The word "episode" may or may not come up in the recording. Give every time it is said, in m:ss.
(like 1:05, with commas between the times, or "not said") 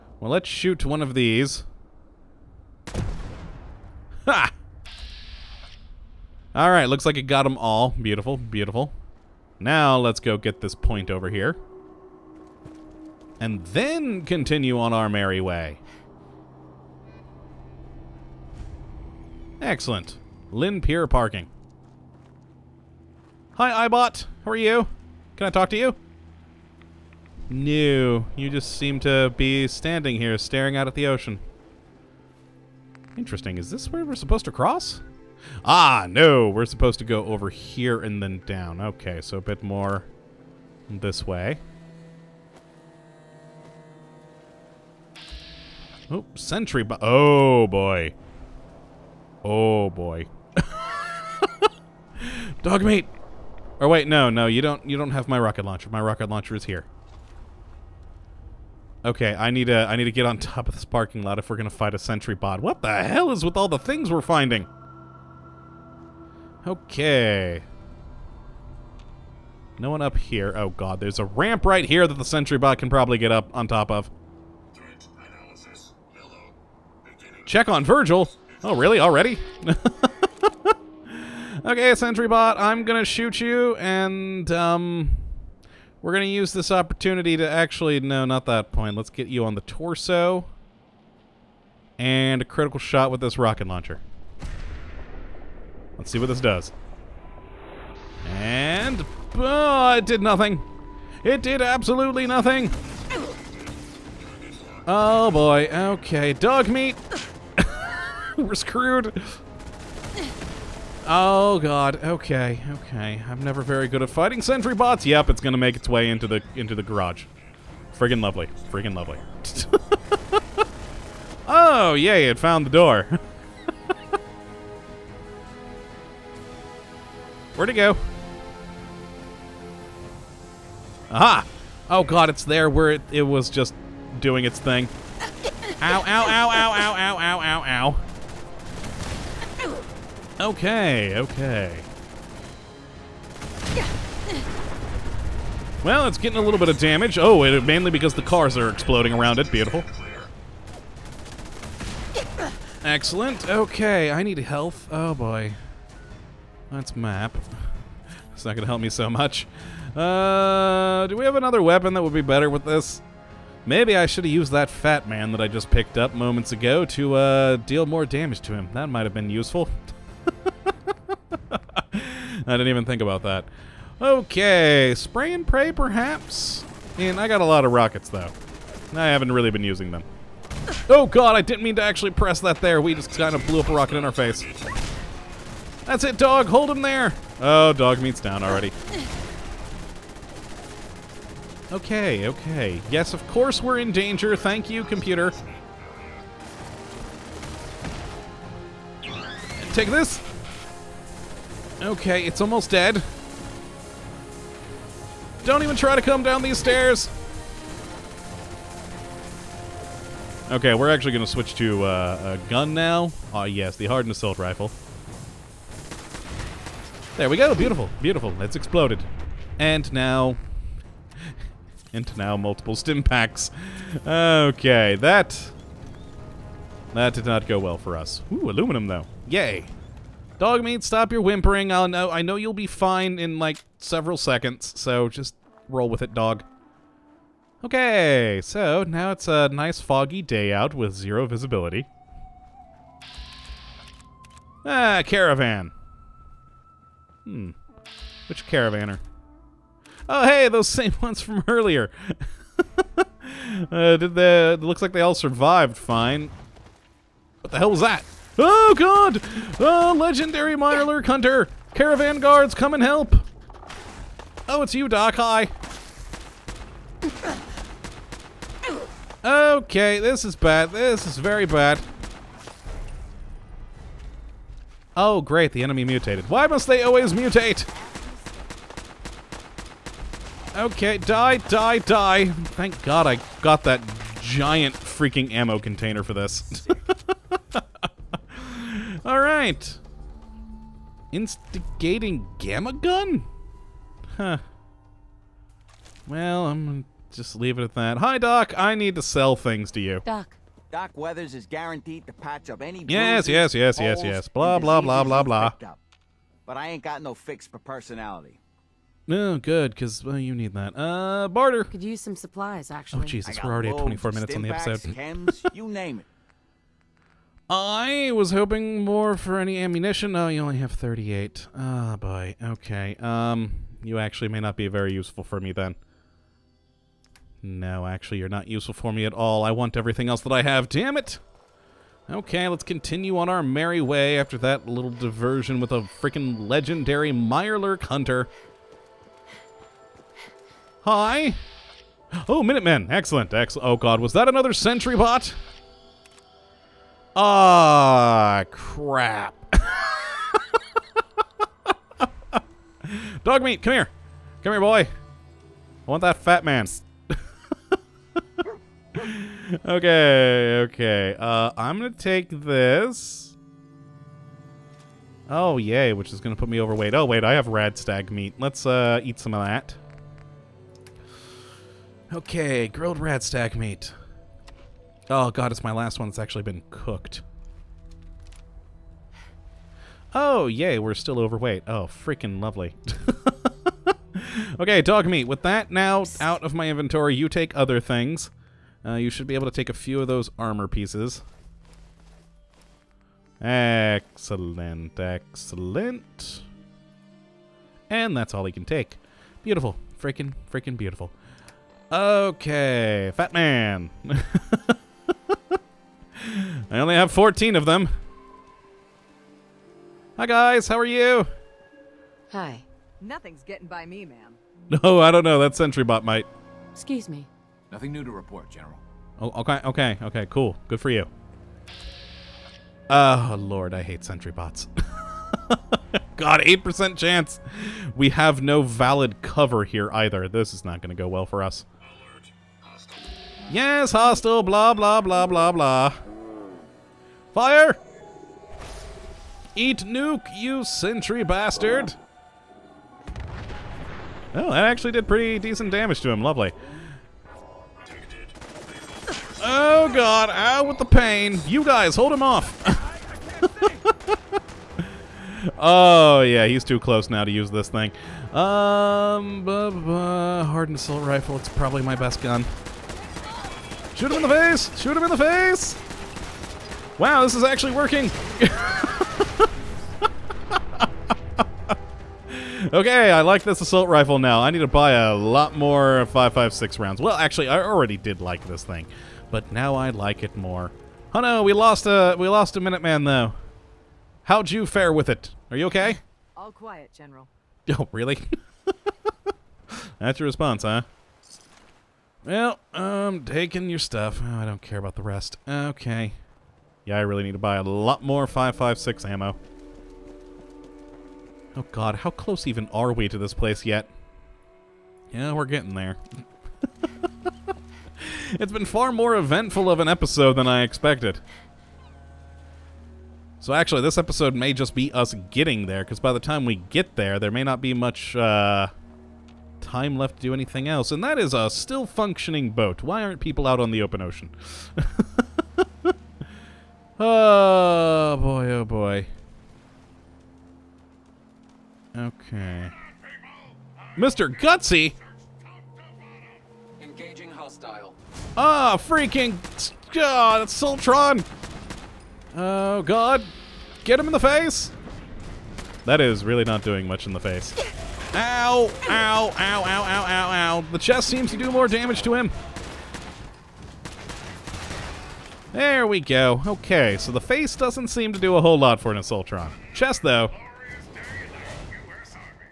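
5:14, 8:29, 8:33.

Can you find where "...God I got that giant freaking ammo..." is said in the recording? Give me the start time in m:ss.
4:42.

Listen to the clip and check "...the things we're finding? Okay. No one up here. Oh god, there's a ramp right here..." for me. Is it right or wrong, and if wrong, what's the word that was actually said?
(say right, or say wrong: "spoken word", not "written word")
right.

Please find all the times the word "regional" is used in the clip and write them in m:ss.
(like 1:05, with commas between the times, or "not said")
not said.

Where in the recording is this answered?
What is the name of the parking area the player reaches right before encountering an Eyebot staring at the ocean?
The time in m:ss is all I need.
0:20.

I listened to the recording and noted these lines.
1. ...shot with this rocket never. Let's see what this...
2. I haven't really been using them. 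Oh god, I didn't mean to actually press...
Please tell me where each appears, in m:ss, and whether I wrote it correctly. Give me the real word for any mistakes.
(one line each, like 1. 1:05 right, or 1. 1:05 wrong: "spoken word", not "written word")
1. 1:32 wrong: "launcher", not "never"
2. 2:58 right.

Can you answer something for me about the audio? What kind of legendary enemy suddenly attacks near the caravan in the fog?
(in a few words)
minor hunter.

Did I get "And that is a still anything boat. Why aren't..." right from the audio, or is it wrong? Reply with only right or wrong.
wrong.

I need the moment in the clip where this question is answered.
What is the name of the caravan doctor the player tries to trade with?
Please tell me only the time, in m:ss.
5:00.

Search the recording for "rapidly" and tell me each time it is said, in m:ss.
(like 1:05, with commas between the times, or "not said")
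not said.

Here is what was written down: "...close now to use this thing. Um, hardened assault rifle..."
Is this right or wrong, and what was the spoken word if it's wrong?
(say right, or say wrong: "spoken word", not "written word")
right.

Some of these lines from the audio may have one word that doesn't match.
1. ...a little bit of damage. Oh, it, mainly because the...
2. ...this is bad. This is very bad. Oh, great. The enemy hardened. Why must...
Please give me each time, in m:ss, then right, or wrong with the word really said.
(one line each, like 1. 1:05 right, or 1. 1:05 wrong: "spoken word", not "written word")
1. 2:26 right
2. 4:29 wrong: "mutated", not "hardened".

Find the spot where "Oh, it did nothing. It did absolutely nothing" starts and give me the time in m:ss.
1:39.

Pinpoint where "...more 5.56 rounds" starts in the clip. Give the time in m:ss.
7:55.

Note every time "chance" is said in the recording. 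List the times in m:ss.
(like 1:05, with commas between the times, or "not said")
7:06.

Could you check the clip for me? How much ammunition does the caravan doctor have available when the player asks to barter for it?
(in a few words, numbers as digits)
38.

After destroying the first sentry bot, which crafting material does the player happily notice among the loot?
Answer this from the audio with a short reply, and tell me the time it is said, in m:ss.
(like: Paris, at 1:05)
aluminum, at 3:48.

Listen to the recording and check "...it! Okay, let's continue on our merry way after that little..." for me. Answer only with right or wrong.
right.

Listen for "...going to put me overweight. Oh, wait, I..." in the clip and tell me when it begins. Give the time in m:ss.
6:06.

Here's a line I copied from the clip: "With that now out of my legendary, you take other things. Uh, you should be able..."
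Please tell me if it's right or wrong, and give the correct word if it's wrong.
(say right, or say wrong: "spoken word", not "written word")
wrong: "inventory", not "legendary".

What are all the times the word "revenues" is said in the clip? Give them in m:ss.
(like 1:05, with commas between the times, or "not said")
not said.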